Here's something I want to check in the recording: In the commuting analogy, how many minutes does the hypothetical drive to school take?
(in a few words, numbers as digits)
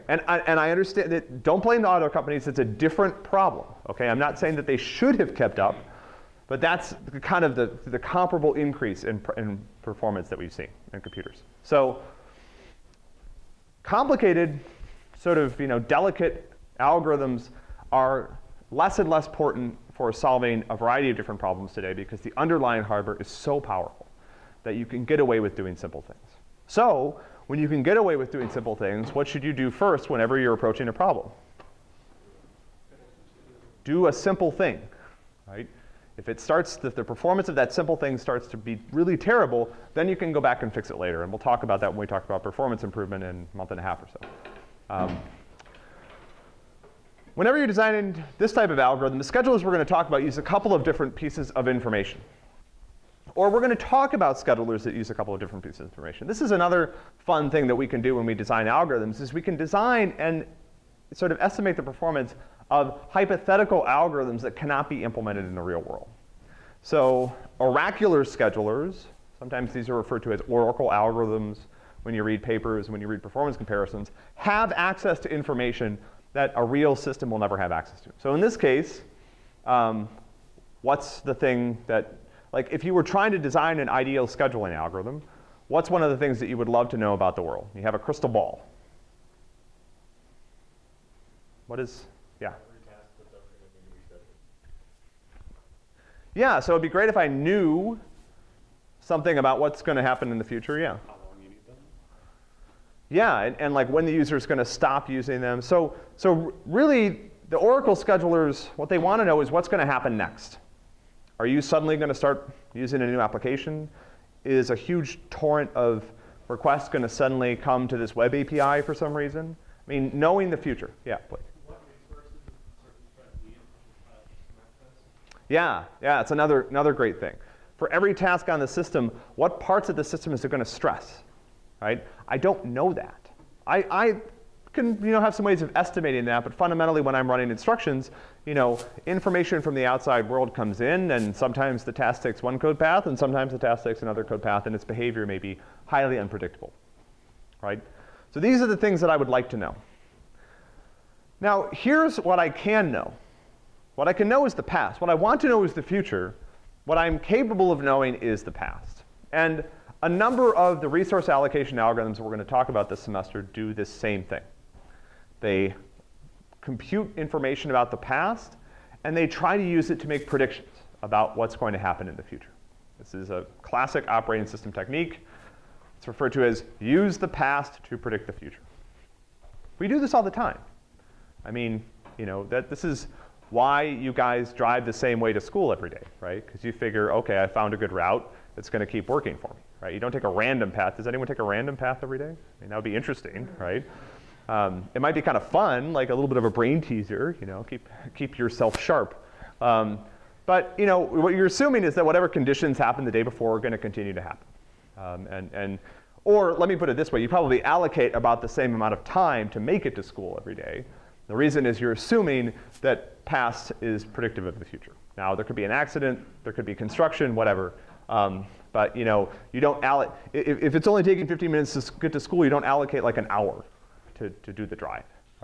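15 minutes.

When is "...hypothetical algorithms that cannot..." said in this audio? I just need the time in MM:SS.
01:03.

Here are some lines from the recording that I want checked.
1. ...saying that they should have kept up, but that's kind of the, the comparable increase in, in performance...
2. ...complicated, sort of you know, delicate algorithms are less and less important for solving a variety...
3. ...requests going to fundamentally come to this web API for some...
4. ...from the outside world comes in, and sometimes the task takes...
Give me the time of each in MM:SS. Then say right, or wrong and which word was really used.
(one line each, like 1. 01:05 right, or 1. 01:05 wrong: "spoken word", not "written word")
1. 00:04 right
2. 00:13 right
3. 01:56 wrong: "suddenly", not "fundamentally"
4. 02:19 right.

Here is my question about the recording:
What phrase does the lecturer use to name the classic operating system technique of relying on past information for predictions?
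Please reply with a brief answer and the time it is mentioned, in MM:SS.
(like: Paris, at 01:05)
use the past to predict the future, at 02:56.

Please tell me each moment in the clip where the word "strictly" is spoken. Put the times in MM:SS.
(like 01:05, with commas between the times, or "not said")
not said.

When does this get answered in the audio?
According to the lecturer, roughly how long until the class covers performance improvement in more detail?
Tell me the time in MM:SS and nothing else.
00:43.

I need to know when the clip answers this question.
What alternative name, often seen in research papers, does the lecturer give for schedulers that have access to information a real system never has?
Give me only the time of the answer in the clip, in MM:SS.
01:10.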